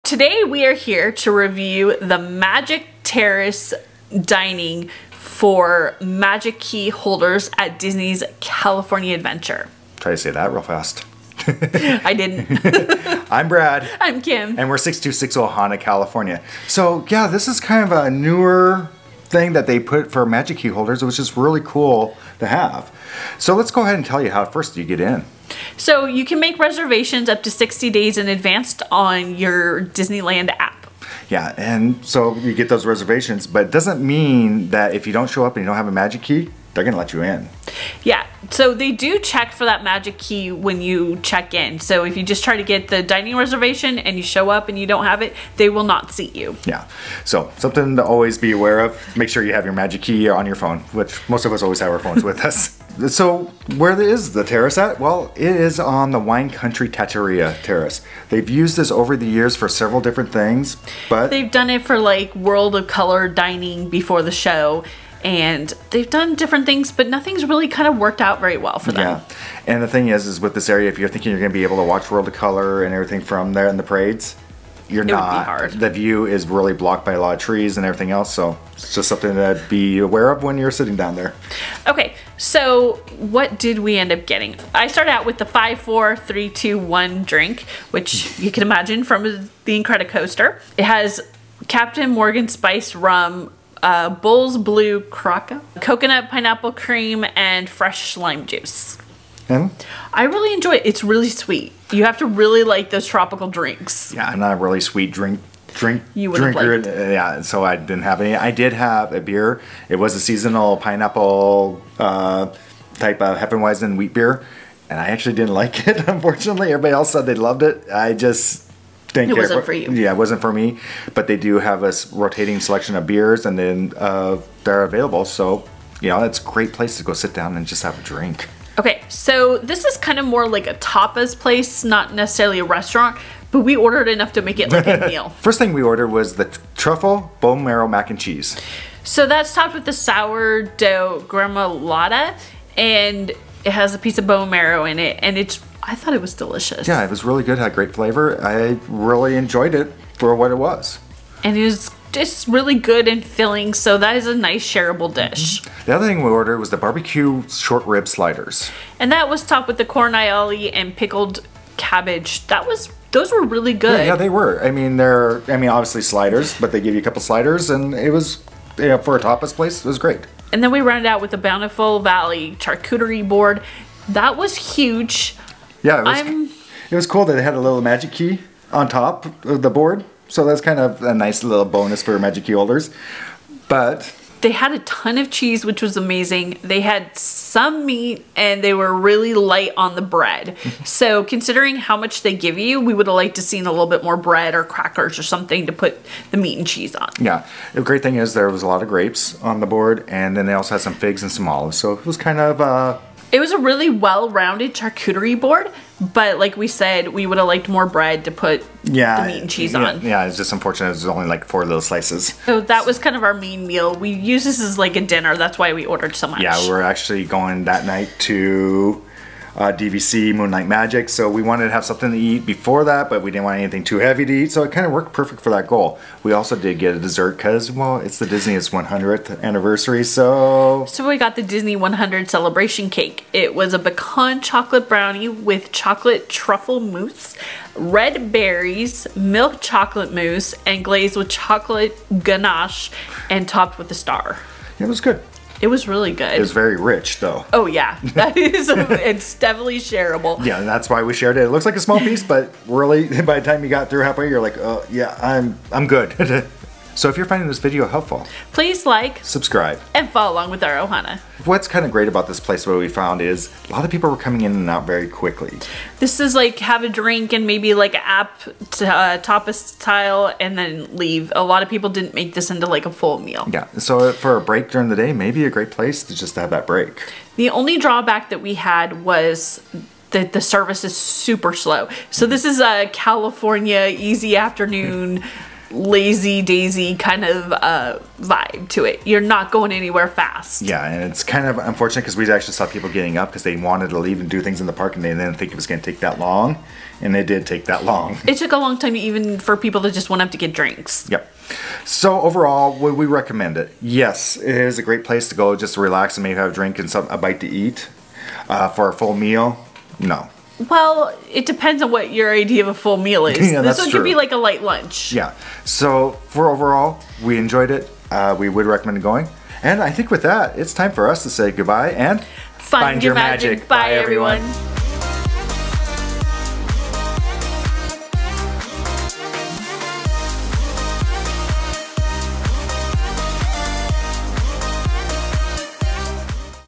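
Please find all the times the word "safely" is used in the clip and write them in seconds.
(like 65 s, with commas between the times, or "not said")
not said.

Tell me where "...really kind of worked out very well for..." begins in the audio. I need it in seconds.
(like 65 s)
67 s.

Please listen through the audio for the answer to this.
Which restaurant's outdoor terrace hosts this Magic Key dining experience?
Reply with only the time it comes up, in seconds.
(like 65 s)
56 s.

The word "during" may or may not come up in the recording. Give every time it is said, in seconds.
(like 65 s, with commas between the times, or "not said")
274 s.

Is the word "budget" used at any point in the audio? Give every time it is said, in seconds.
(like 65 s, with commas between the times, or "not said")
not said.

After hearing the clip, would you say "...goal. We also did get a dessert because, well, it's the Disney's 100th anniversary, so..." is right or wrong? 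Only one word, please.
right.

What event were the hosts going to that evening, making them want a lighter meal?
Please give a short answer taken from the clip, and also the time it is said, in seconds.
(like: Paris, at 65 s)
DVC Moonlight Magic, at 219 s.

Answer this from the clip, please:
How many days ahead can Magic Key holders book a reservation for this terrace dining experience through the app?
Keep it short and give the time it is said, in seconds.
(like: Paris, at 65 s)
60, at 27 s.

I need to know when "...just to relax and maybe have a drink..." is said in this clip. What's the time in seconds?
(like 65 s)
305 s.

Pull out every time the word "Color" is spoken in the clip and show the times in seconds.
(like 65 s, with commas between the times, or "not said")
62 s, 72 s.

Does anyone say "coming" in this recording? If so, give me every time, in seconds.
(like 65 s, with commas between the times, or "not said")
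264 s.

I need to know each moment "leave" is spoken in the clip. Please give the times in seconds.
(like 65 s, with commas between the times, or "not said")
270 s, 293 s.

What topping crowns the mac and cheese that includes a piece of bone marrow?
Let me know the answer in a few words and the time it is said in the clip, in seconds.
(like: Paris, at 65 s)
sourdough gremolata, at 139 s.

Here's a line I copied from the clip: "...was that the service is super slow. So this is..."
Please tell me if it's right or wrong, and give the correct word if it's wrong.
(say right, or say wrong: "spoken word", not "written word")
right.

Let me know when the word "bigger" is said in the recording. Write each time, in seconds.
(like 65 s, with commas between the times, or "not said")
not said.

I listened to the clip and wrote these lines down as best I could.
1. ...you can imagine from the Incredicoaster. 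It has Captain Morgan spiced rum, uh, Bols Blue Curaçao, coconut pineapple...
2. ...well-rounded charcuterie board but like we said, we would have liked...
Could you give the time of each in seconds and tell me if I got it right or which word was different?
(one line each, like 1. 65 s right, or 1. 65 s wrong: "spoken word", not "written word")
1. 88 s right
2. 203 s right.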